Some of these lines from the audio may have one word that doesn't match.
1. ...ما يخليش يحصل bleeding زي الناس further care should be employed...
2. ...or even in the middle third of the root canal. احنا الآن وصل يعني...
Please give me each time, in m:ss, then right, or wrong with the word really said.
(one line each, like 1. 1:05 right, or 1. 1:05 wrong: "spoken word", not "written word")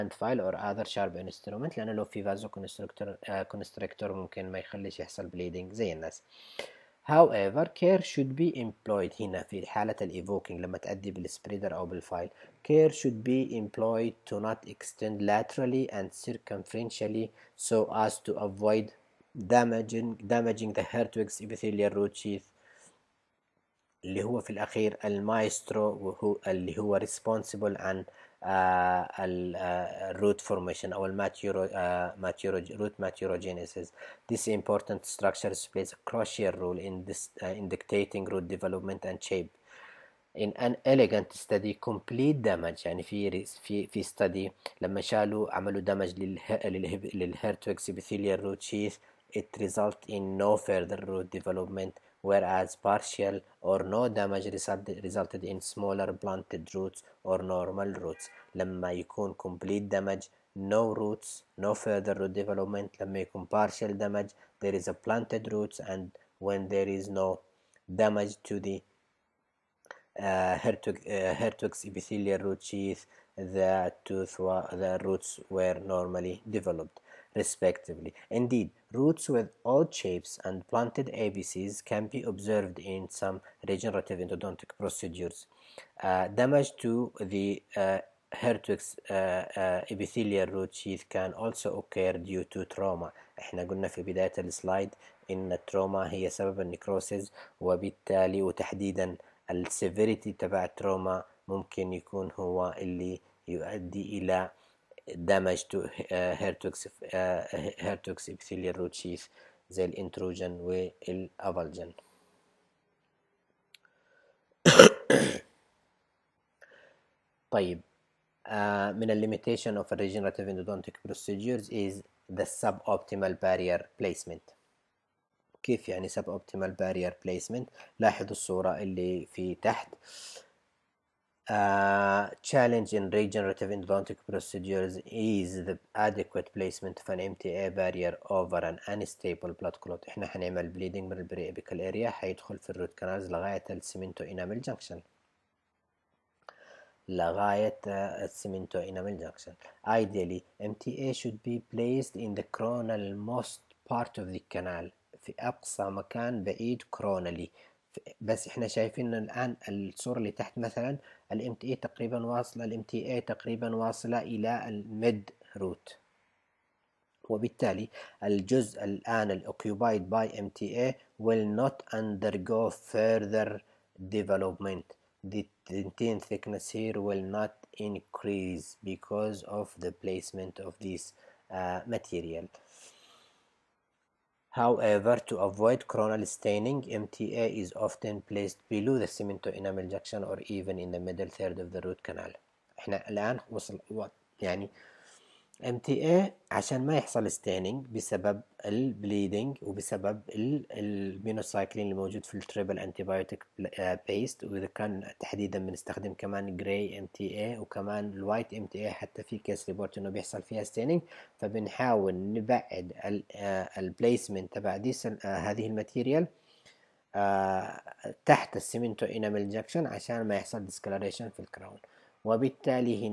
1. 0:04 wrong: "however", not "further"
2. 3:10 right.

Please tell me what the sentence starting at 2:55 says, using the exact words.
The dentin thickness here will not increase because of the placement of this uh, material.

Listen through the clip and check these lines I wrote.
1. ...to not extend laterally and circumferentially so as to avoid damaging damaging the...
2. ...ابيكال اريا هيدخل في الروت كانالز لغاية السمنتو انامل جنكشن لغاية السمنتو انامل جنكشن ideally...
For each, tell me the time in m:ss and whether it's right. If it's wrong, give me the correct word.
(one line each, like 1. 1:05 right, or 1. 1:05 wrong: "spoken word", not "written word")
1. 0:14 right
2. 2:21 right.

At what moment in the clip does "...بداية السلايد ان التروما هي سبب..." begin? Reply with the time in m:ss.
1:34.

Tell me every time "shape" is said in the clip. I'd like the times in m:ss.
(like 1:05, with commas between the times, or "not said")
0:39, 1:19.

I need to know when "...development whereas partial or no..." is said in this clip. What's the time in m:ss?
0:51.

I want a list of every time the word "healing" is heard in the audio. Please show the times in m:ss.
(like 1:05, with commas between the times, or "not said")
not said.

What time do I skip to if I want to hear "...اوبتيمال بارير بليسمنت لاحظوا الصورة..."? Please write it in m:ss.
2:06.